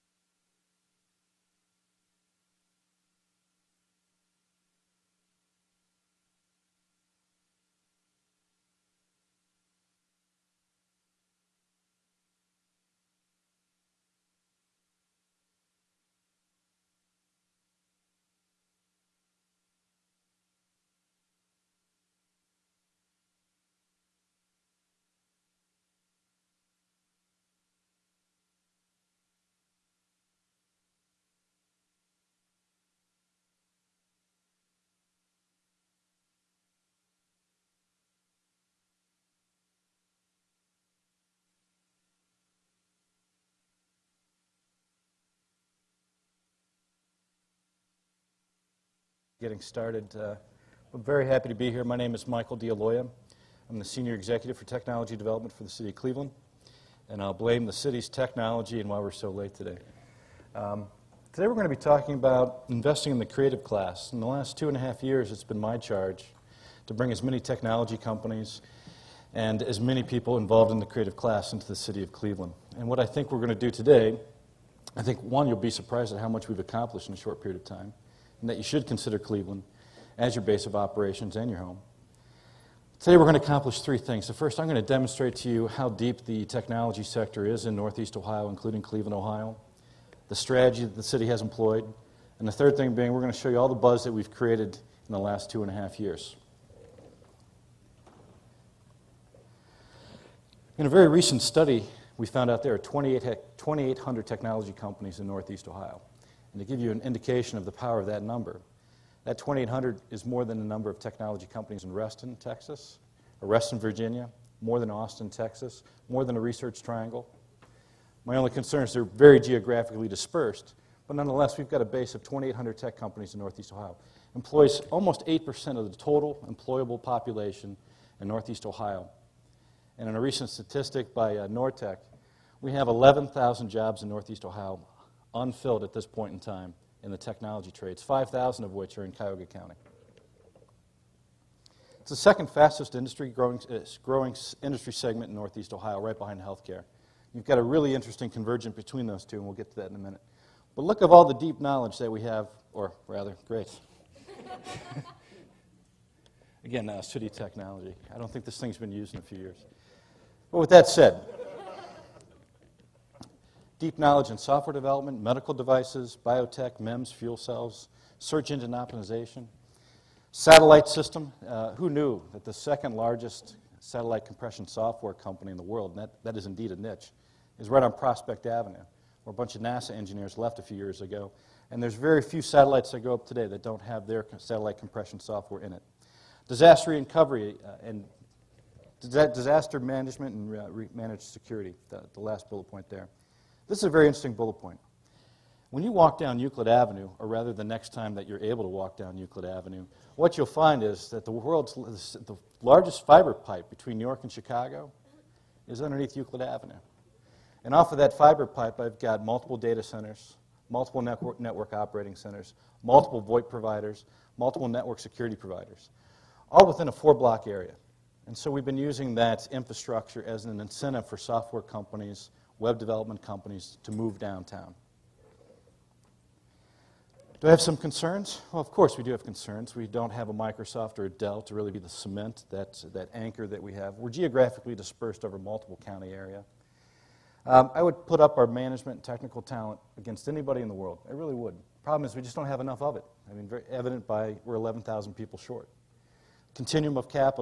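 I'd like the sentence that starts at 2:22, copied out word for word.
It's the second fastest industry growing, uh, growing industry segment in Northeast Ohio, right behind healthcare.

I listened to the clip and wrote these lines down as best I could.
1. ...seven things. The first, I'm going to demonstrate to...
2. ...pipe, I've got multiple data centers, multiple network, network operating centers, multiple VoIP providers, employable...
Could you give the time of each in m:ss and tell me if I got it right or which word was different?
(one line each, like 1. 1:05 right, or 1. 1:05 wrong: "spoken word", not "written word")
1. 1:23 wrong: "three", not "seven"
2. 3:28 wrong: "multiple", not "employable".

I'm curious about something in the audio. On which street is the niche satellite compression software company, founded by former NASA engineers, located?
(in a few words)
Prospect Avenue.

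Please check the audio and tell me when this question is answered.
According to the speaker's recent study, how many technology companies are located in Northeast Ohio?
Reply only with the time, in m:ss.
1:42.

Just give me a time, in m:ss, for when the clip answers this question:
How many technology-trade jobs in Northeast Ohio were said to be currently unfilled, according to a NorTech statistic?
2:12.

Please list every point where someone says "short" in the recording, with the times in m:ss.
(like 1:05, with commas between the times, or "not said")
1:17, 4:05.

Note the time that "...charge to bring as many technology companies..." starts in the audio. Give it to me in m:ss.
1:05.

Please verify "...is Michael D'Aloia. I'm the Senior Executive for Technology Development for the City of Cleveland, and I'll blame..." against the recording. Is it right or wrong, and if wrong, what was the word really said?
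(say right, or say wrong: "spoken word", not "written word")
right.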